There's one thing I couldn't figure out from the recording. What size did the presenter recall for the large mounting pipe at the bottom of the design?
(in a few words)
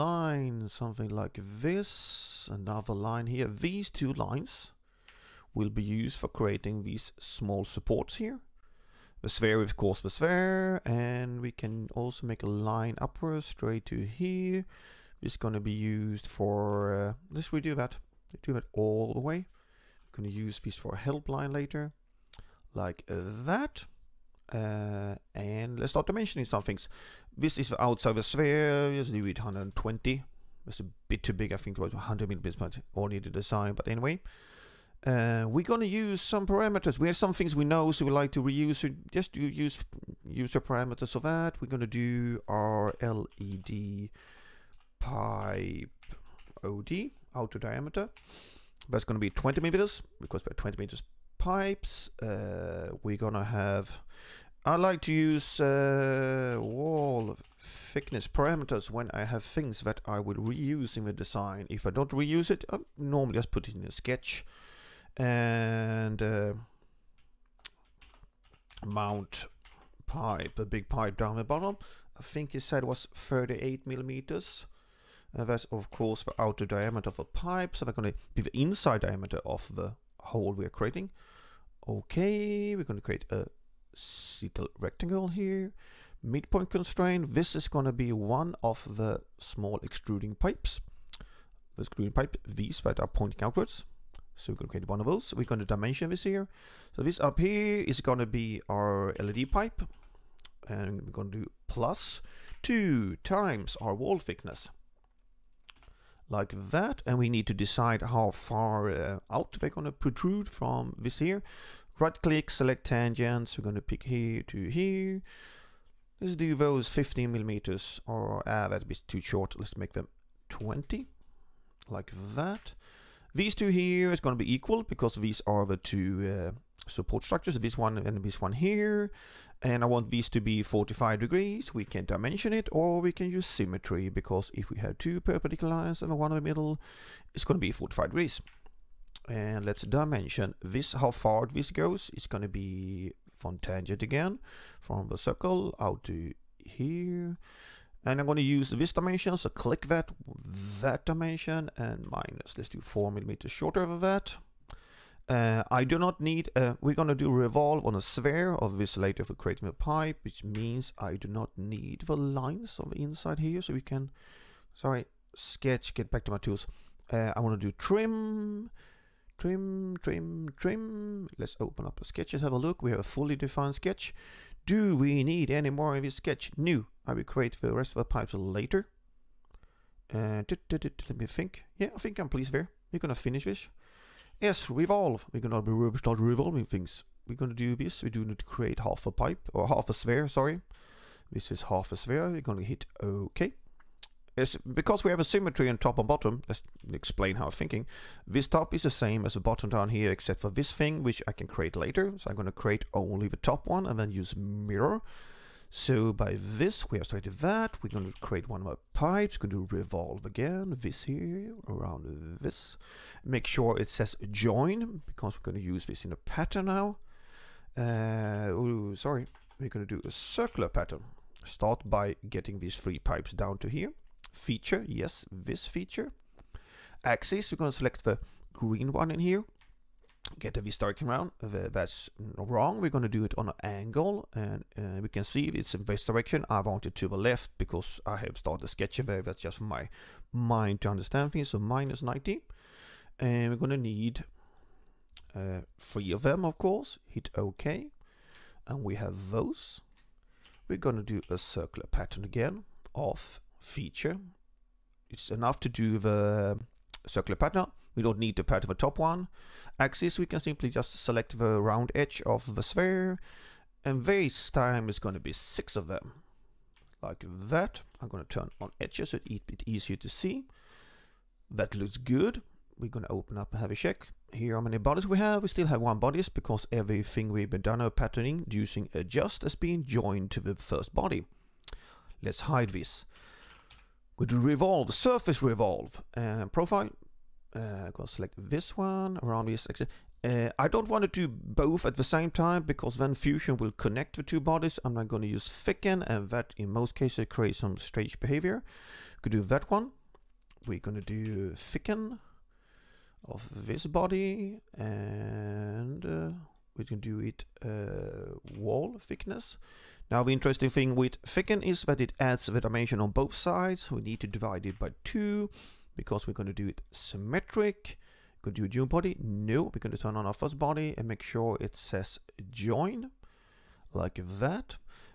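38 millimeters.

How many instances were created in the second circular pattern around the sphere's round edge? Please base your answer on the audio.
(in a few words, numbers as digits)
6.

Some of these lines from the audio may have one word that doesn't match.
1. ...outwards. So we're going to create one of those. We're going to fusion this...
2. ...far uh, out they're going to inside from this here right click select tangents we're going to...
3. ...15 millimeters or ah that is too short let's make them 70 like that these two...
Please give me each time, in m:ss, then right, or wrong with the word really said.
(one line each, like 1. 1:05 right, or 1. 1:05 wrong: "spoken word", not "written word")
1. 1:33 wrong: "dimension", not "fusion"
2. 1:48 wrong: "protrude", not "inside"
3. 1:56 wrong: "20", not "70".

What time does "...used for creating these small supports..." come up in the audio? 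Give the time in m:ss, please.
0:05.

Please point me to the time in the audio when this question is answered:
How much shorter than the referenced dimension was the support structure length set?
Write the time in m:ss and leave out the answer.
2:32.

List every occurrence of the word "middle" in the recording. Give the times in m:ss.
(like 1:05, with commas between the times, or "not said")
2:16.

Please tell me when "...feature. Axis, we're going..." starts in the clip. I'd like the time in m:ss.
3:45.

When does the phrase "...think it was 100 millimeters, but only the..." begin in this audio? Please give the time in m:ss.
0:31.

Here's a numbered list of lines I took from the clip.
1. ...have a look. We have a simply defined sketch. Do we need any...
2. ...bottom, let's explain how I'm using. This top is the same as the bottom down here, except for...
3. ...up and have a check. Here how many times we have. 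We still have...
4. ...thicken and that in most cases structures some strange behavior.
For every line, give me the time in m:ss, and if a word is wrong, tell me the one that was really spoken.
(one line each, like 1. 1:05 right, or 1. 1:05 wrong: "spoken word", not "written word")
1. 2:52 wrong: "fully", not "simply"
2. 3:16 wrong: "thinking", not "using"
3. 4:33 wrong: "bodies", not "times"
4. 4:55 wrong: "creates", not "structures".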